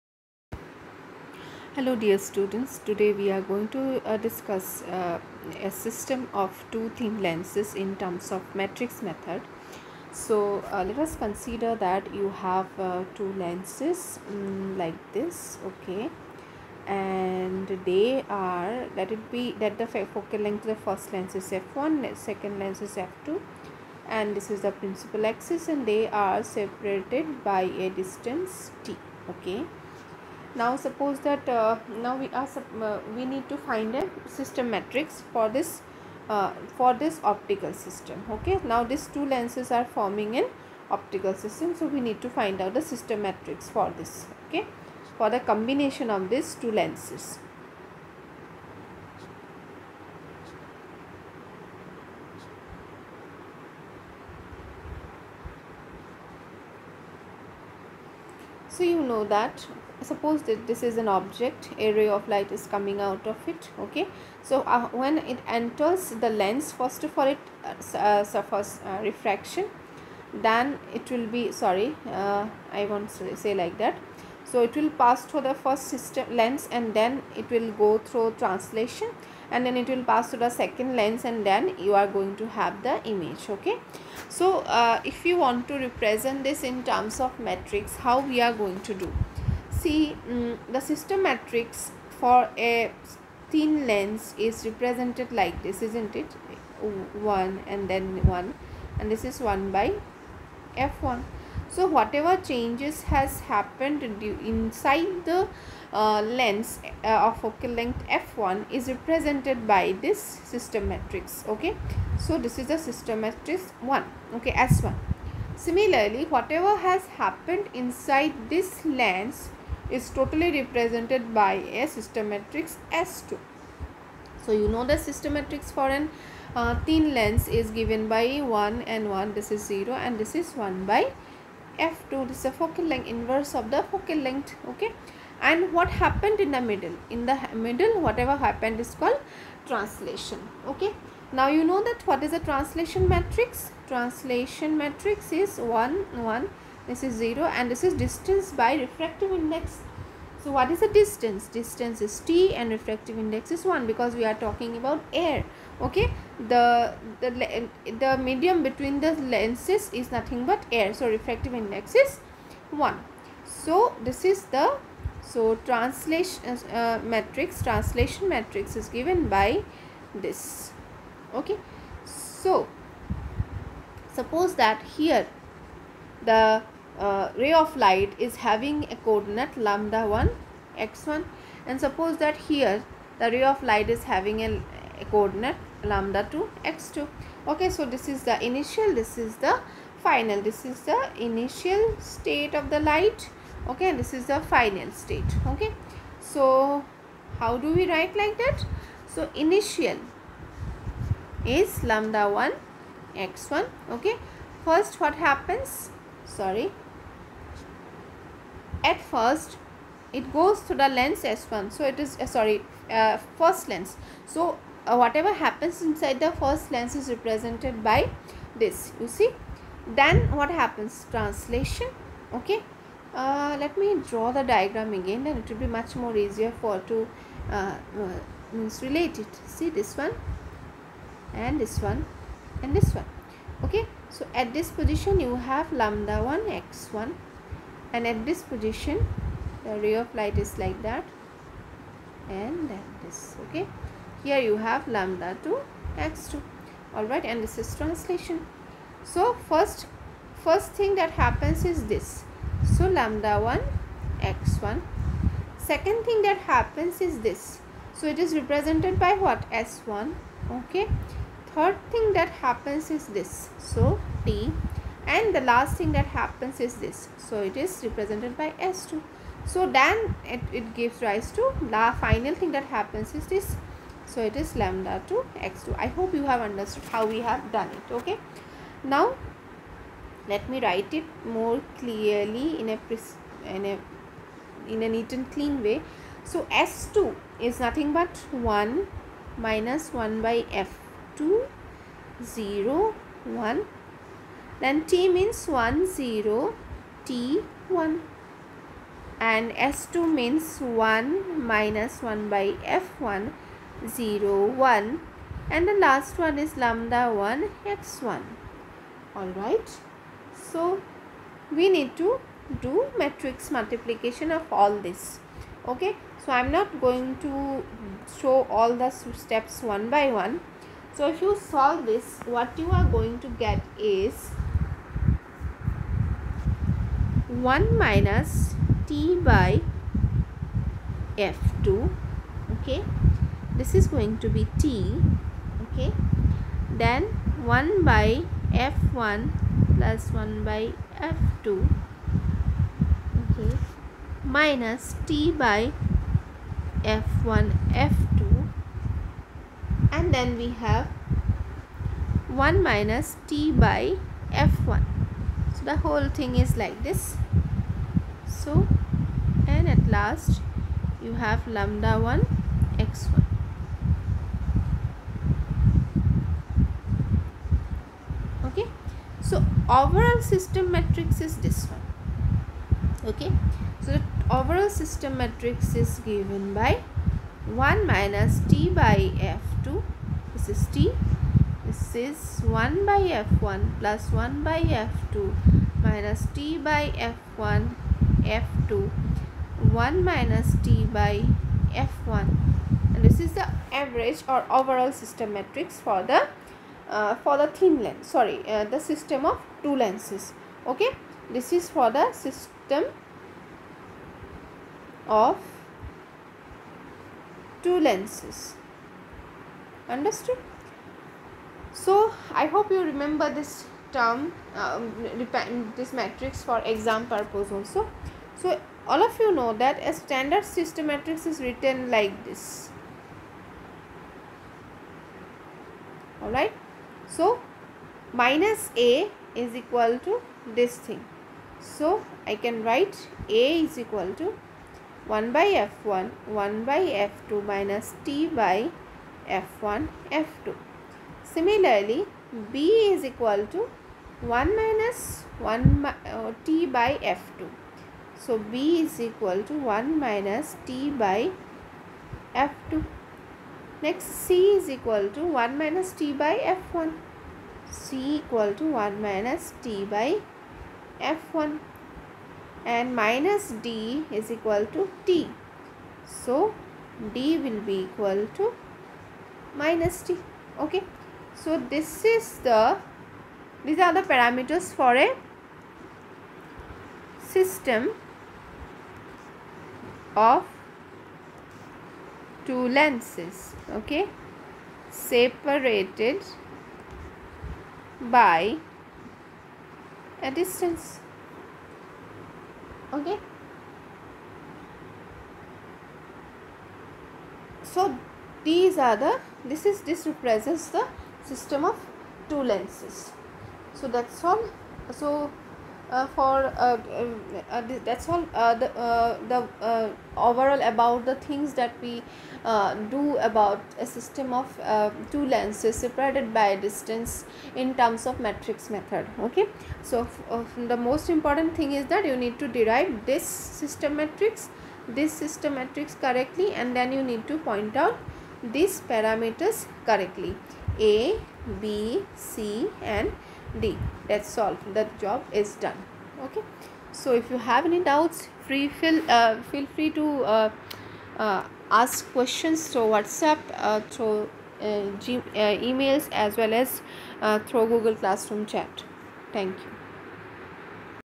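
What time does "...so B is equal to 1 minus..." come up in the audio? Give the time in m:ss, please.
7:28.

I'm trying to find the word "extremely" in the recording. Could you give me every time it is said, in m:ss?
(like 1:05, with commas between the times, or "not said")
not said.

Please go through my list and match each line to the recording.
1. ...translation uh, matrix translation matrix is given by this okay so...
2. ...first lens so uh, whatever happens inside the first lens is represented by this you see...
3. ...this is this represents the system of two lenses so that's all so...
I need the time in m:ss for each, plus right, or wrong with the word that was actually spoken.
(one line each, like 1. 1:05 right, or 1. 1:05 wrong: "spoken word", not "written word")
1. 2:45 right
2. 3:33 right
3. 8:19 right.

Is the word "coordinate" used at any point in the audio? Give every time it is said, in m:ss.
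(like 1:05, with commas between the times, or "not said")
2:59, 3:05.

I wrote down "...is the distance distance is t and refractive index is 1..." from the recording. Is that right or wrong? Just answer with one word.
right.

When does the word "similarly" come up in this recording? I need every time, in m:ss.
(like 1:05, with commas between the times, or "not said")
1:55, 7:21.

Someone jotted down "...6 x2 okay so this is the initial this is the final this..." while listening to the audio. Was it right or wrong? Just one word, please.
wrong.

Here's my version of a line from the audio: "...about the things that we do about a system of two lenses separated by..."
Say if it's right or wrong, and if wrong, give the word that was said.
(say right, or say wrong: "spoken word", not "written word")
right.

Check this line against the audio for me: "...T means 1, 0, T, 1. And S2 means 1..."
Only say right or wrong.
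right.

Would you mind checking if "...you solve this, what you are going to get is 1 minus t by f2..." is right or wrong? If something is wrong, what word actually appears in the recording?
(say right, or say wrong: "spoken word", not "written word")
right.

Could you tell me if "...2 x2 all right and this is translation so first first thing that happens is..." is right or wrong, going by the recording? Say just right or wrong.
right.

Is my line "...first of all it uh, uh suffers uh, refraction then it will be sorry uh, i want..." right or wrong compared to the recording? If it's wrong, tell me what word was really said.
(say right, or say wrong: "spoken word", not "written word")
right.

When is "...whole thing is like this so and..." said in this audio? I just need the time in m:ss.
5:55.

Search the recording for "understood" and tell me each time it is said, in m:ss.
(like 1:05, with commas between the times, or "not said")
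4:36, 6:49.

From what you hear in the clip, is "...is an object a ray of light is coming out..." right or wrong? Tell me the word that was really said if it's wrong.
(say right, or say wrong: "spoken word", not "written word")
right.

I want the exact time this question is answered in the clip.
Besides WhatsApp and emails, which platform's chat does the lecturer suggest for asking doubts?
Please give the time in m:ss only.
9:07.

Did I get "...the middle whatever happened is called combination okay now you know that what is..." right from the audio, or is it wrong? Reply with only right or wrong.
wrong.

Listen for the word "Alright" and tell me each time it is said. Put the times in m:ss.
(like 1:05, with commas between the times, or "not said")
5:09, 7:06.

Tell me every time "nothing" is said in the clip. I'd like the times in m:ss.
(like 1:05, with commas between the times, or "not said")
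2:40, 4:47.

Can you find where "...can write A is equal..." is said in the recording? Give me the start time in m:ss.
7:12.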